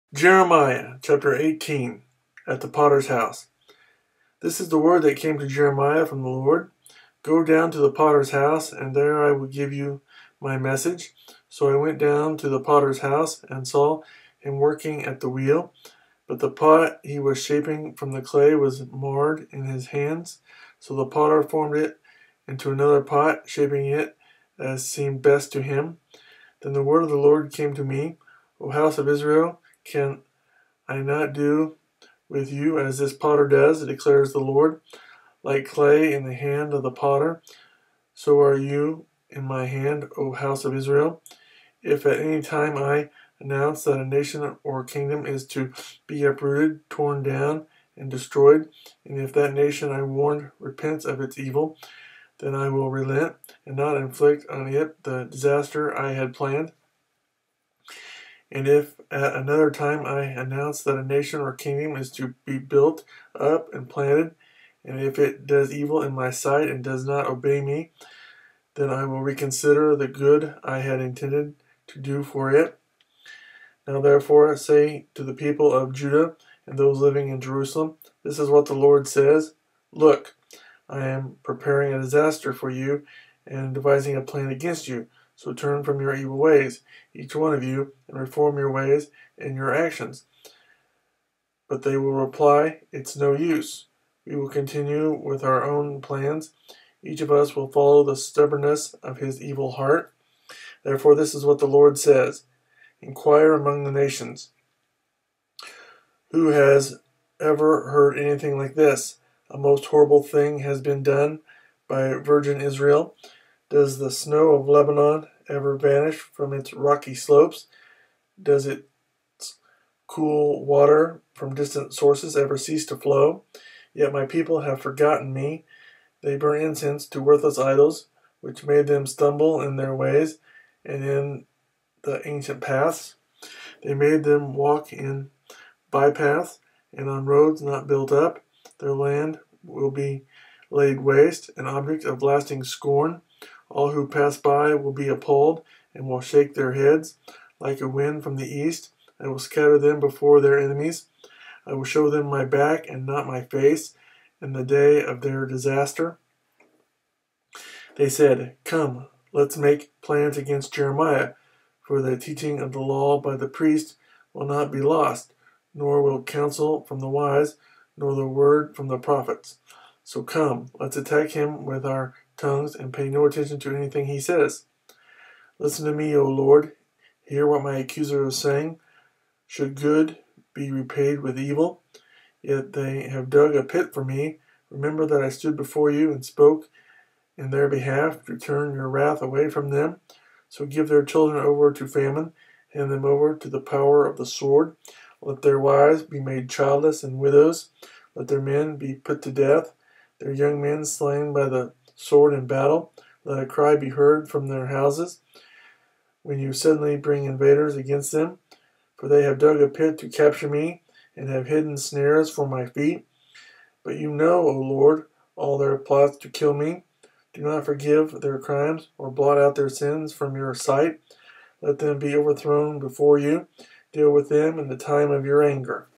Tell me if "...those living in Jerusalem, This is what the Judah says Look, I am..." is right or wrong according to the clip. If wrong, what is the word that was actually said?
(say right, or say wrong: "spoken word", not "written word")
wrong: "Lord", not "Judah".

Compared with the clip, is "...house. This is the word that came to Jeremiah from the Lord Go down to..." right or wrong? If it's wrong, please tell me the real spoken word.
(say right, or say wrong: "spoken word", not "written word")
right.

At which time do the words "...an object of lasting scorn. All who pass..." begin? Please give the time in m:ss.
2:21.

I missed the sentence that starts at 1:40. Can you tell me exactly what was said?
Therefore, this is what the Lord says Inquire among the nations.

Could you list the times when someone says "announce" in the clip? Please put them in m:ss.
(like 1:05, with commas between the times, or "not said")
0:43, 1:00.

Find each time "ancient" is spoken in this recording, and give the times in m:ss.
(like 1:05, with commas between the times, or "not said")
2:12.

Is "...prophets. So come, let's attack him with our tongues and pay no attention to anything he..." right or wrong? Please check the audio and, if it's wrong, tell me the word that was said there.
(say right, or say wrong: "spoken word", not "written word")
right.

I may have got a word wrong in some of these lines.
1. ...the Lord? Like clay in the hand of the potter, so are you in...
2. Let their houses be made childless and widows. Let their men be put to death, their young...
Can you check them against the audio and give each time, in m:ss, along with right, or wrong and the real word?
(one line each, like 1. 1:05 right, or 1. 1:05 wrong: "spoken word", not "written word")
1. 0:34 right
2. 3:15 wrong: "wives", not "houses".